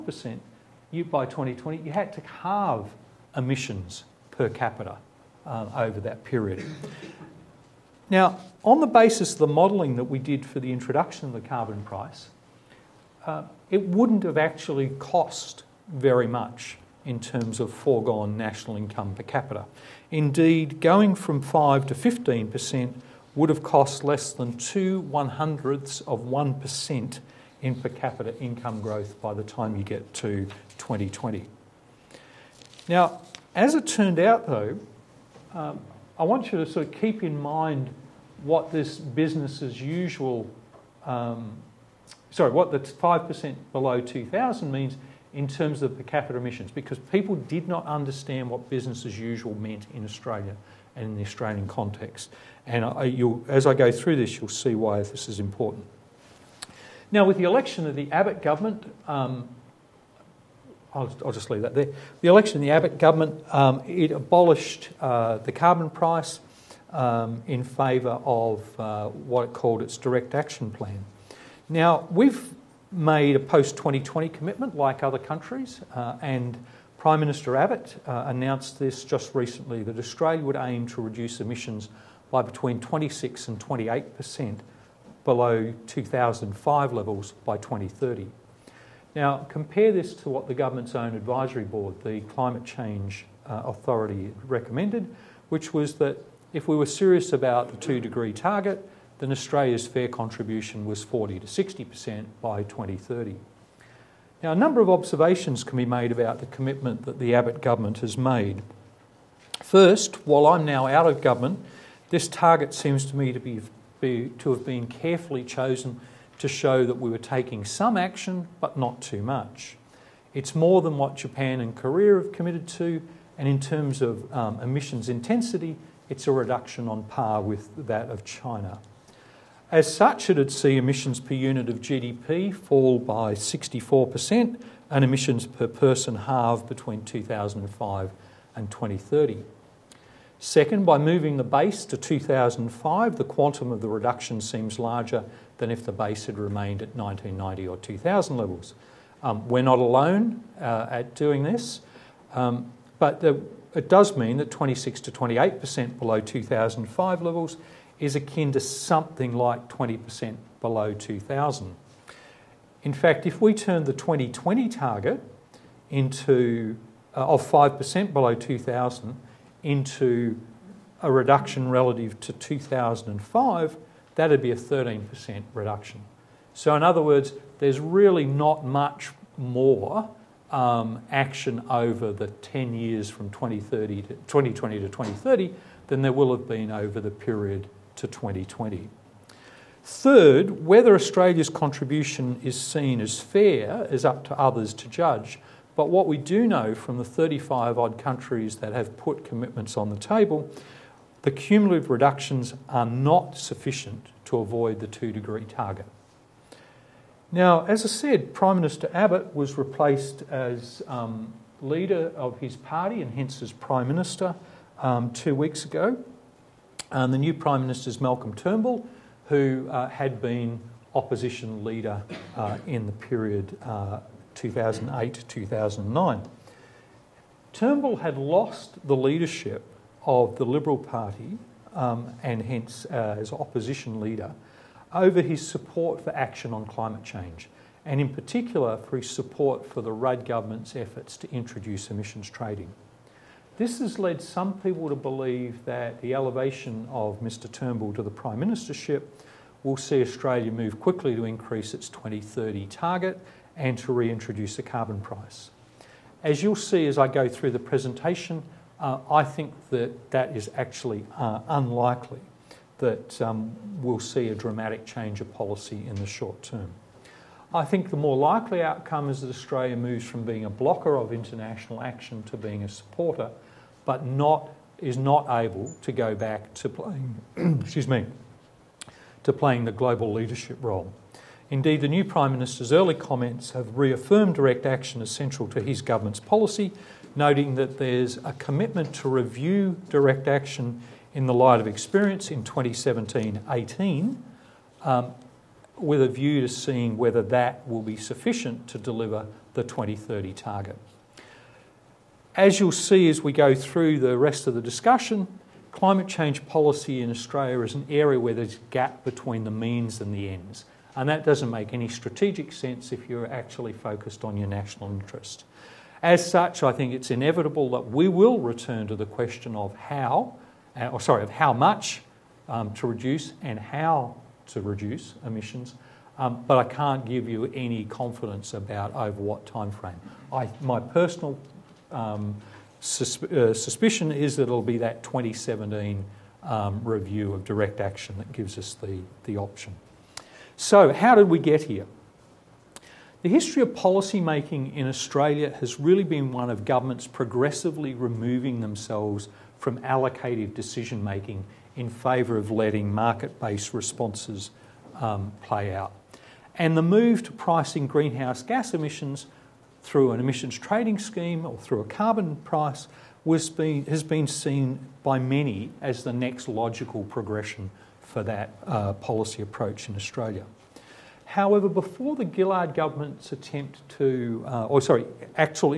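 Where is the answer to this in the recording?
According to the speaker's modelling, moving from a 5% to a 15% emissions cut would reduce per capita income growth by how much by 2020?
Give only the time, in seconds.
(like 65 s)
24 s.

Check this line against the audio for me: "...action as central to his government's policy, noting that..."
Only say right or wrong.
right.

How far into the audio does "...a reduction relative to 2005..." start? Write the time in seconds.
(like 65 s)
171 s.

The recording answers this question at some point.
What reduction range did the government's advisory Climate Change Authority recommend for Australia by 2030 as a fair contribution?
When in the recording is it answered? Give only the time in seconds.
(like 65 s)
101 s.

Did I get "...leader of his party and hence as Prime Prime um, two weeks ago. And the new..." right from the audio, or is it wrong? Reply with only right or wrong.
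wrong.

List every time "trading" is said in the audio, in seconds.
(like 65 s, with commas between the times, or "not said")
242 s, 360 s.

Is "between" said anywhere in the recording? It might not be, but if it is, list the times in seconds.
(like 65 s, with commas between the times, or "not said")
82 s, 136 s, 309 s.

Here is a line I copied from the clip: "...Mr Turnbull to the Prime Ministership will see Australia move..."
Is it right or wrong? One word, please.
right.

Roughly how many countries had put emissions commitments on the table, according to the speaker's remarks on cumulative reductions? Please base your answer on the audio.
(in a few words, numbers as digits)
35.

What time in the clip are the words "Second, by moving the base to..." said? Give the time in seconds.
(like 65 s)
140 s.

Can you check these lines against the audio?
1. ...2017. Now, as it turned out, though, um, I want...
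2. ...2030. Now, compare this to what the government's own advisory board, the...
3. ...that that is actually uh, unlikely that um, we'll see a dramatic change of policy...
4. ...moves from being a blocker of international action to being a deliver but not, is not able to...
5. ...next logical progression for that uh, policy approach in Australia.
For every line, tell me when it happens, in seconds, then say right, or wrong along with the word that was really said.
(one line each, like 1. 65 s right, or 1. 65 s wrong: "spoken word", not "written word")
1. 30 s wrong: "2020", not "2017"
2. 87 s right
3. 259 s right
4. 269 s wrong: "supporter", not "deliver"
5. 366 s right.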